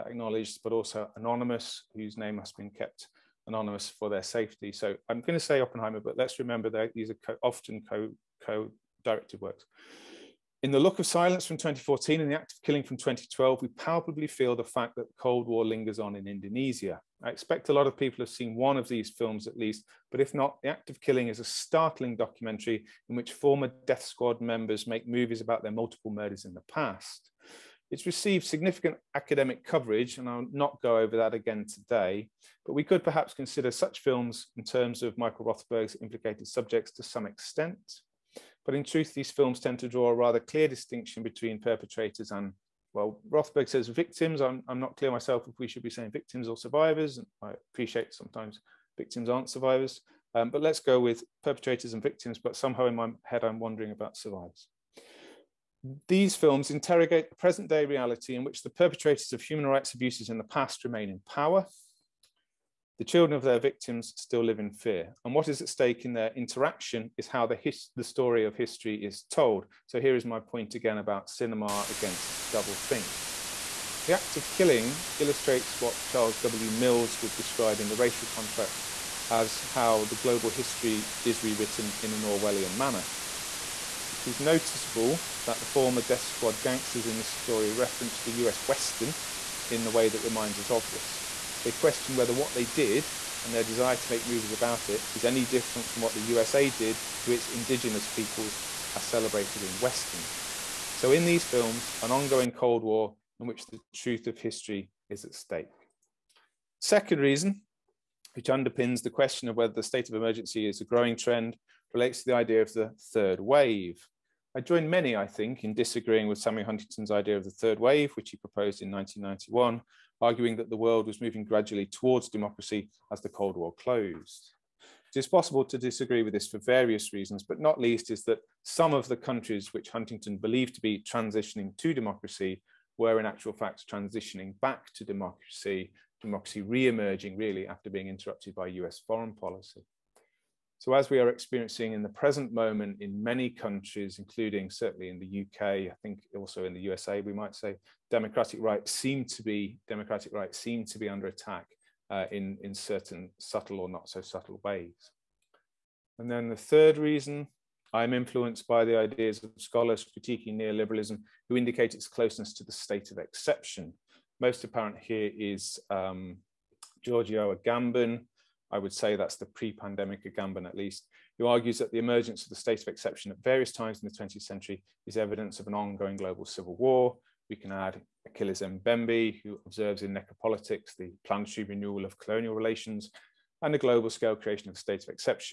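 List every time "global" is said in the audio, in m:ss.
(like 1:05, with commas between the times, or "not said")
1:20, 2:56, 3:03.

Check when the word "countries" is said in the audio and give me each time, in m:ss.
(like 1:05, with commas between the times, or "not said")
2:09, 2:23.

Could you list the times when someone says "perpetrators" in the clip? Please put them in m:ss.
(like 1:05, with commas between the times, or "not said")
0:41, 0:51, 0:58.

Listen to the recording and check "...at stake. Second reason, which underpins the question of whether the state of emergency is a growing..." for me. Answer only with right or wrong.
right.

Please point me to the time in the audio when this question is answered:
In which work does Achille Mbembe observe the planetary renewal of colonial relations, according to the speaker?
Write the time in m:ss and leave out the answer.
3:00.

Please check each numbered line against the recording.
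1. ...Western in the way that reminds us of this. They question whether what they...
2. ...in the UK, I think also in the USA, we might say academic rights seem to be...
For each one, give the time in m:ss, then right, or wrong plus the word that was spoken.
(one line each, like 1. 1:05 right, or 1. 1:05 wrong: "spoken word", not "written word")
1. 1:28 right
2. 2:25 wrong: "democratic", not "academic".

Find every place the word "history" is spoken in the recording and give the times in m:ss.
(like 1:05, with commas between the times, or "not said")
1:08, 1:20, 1:44.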